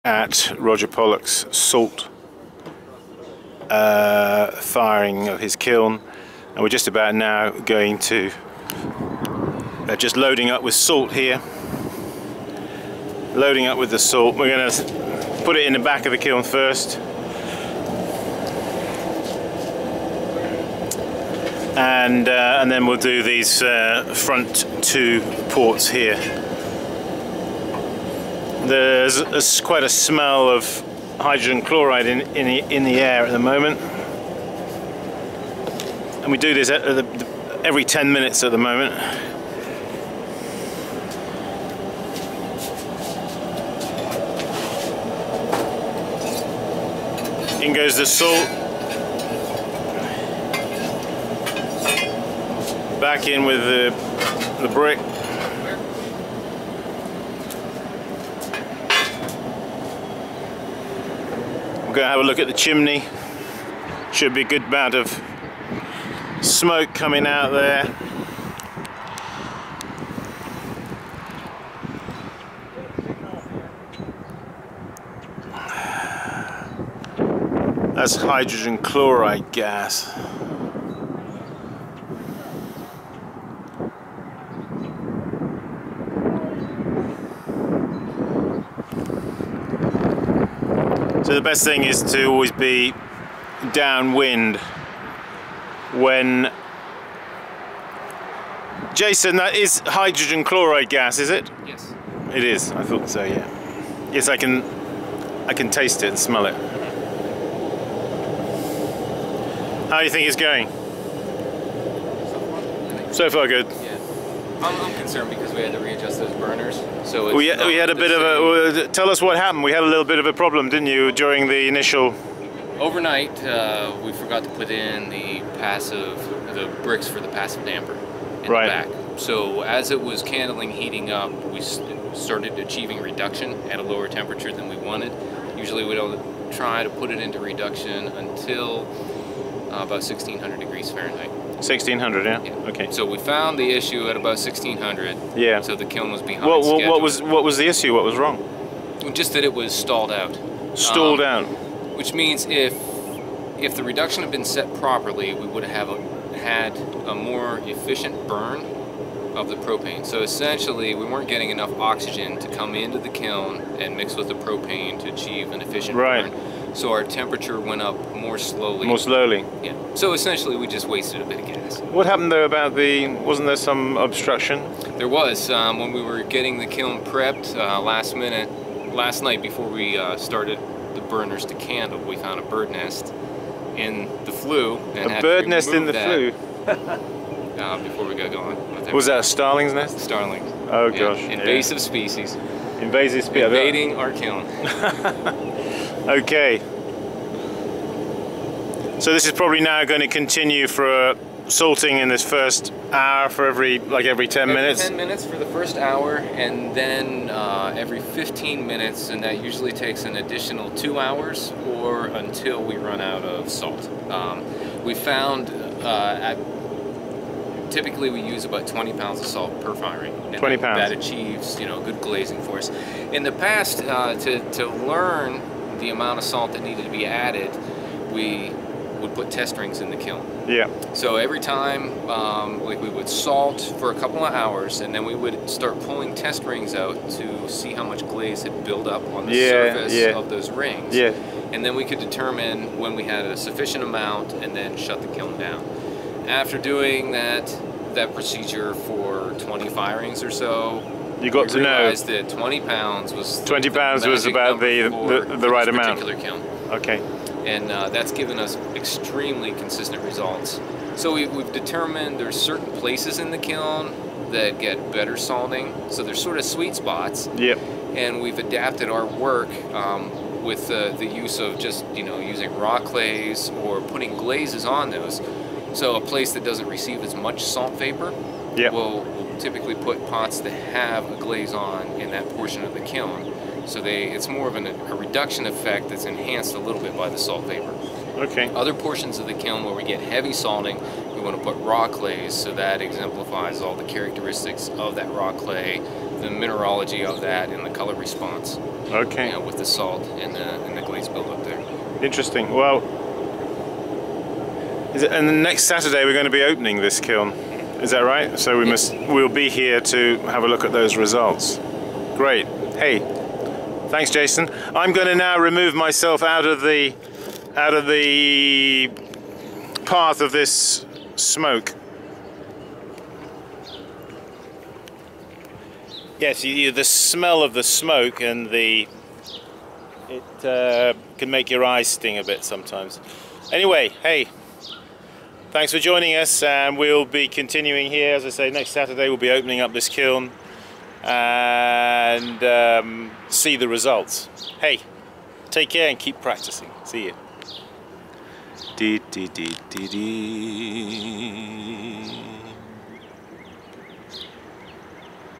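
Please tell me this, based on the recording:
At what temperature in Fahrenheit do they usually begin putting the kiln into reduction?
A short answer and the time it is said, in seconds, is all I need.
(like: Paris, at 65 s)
1600 degrees Fahrenheit, at 140 s.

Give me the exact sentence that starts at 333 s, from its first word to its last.
Anyway, hey, Thanks for joining us and we'll be continuing here.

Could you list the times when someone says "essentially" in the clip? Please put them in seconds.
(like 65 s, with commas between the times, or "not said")
160 s, 170 s.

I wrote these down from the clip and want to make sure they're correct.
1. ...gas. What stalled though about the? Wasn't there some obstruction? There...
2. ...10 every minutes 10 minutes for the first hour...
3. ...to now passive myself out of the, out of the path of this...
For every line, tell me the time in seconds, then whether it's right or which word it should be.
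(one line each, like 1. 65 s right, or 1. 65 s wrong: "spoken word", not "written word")
1. 171 s wrong: "happened", not "stalled"
2. 204 s right
3. 315 s wrong: "remove", not "passive".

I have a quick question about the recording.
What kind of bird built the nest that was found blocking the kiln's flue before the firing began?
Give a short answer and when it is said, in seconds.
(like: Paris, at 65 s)
Starlings, at 189 s.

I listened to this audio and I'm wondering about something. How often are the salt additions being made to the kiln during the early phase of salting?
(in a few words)
every 10 minutes.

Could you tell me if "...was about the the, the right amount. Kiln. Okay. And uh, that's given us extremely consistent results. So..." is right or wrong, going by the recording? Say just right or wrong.
right.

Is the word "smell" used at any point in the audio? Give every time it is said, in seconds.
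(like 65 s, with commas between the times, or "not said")
29 s, 106 s, 326 s.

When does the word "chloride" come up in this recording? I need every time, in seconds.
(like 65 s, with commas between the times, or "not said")
31 s, 78 s, 100 s.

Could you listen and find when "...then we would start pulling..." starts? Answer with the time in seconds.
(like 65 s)
234 s.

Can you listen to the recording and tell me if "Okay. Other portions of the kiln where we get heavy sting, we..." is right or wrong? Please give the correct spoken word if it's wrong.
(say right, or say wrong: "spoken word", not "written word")
wrong: "salting", not "sting".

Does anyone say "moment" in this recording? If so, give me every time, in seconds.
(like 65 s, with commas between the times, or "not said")
33 s, 38 s.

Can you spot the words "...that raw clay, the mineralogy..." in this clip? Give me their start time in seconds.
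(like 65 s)
294 s.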